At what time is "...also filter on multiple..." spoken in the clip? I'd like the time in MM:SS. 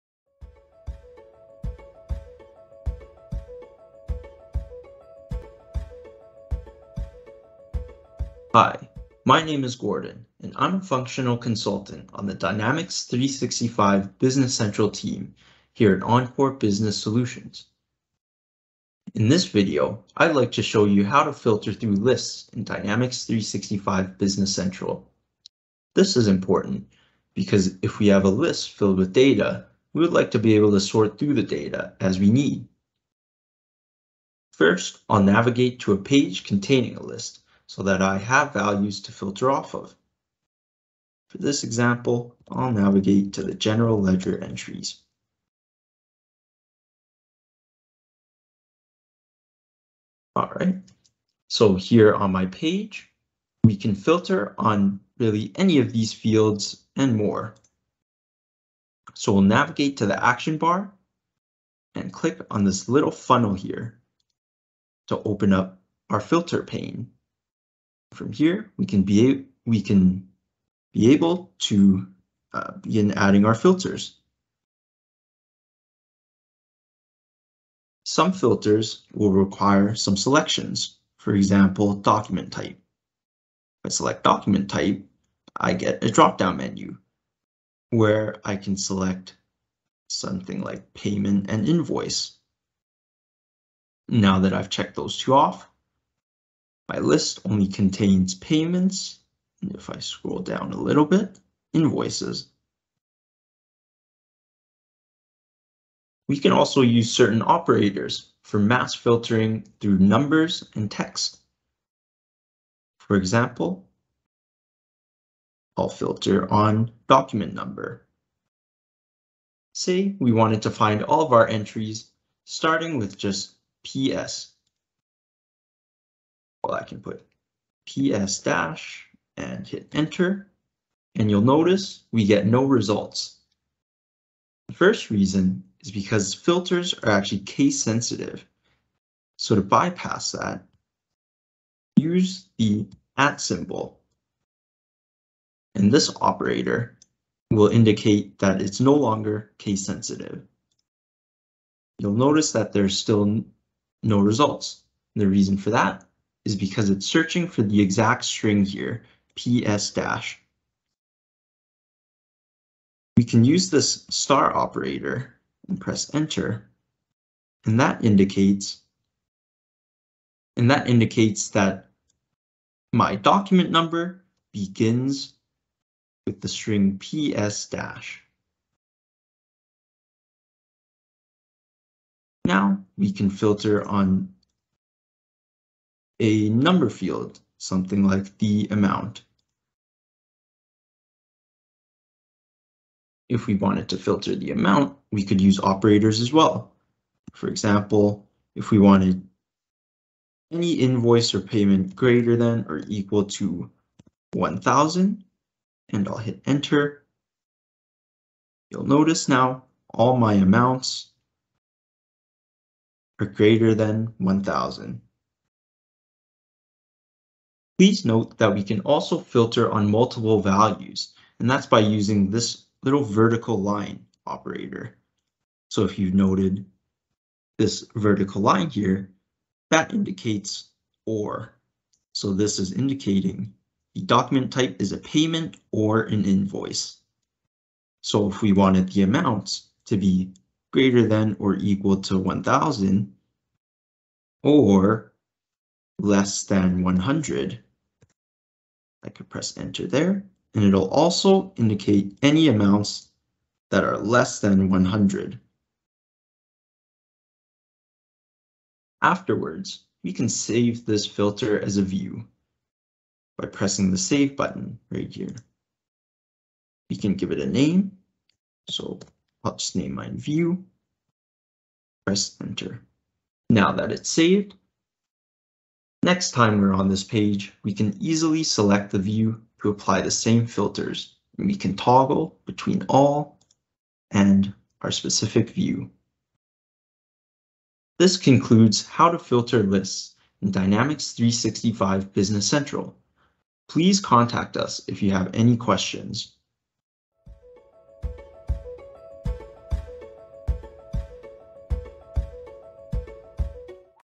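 03:38.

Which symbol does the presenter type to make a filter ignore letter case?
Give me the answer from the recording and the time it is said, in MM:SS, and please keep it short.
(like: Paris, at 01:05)
@ (at symbol), at 02:23.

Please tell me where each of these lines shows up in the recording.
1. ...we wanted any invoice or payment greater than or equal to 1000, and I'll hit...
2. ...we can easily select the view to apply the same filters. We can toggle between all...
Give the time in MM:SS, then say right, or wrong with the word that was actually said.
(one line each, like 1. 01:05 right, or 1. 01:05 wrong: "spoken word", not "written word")
1. 03:18 right
2. 04:37 right.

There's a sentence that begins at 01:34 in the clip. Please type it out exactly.
Now that I've checked those two off, my list only contains payments.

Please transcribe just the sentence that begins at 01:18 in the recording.
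Some filters will require some selections, for example, document type.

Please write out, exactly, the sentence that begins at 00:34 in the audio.
First, I'll navigate to a page containing a list so that I have values to filter off of.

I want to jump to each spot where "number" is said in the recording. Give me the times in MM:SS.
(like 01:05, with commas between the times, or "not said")
01:49, 01:57, 02:53, 03:06.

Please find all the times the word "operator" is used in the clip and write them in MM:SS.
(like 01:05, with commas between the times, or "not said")
01:47, 02:26, 02:44, 03:15, 03:44.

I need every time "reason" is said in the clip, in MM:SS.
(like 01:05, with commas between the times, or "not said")
02:15, 02:35.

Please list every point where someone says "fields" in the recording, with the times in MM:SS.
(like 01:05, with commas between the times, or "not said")
00:56, 03:06.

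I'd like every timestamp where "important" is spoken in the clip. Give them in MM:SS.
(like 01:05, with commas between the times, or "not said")
00:26.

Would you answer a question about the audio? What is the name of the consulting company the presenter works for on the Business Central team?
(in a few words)
Encore Business Solutions.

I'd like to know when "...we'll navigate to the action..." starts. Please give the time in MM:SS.
00:59.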